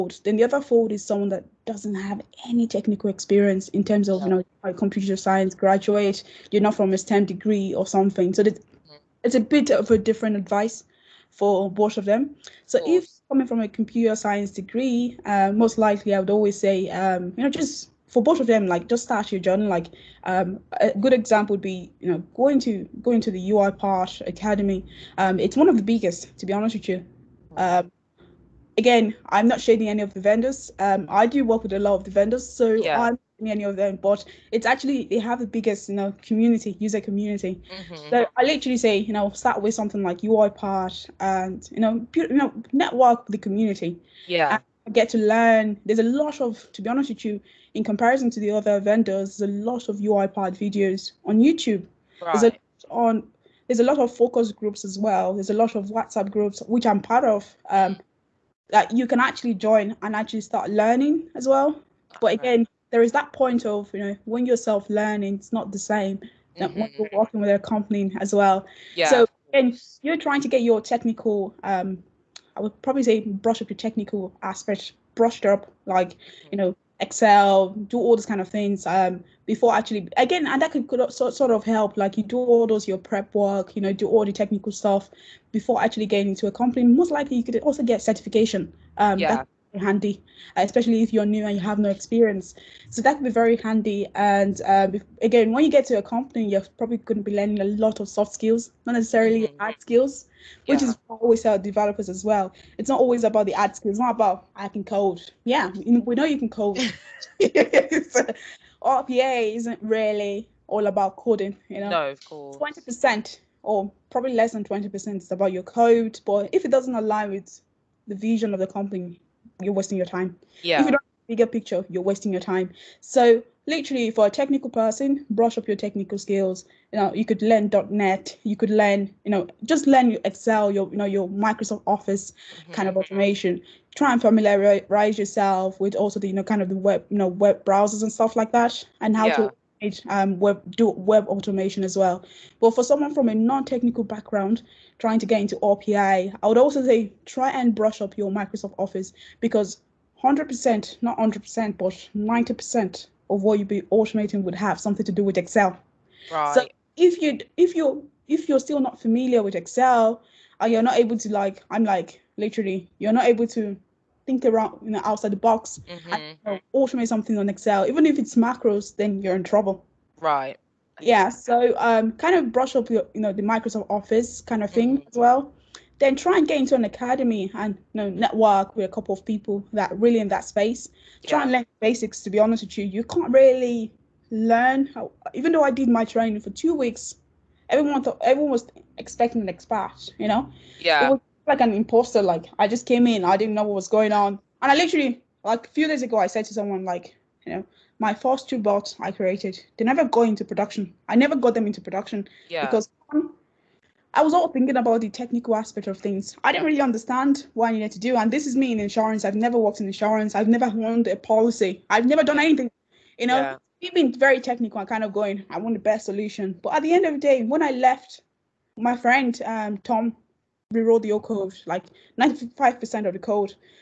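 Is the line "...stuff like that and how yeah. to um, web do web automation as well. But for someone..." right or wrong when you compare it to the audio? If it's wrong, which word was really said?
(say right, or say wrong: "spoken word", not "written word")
right.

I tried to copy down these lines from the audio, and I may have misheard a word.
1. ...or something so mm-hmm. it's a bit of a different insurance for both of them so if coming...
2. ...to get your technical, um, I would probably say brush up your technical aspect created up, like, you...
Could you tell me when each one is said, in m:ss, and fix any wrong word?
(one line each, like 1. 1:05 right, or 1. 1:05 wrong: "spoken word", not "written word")
1. 0:07 wrong: "advice", not "insurance"
2. 1:10 wrong: "brushed", not "created".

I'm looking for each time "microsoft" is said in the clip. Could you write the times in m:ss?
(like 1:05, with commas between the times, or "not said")
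2:11, 2:28, 2:53.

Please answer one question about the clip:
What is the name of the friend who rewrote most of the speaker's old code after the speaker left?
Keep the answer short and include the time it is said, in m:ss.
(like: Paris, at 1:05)
Tom, at 3:39.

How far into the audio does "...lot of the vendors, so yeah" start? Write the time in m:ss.
0:31.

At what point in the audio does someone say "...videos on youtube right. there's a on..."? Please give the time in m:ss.
0:50.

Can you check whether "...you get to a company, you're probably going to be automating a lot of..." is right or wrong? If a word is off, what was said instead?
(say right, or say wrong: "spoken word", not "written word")
wrong: "learning", not "automating".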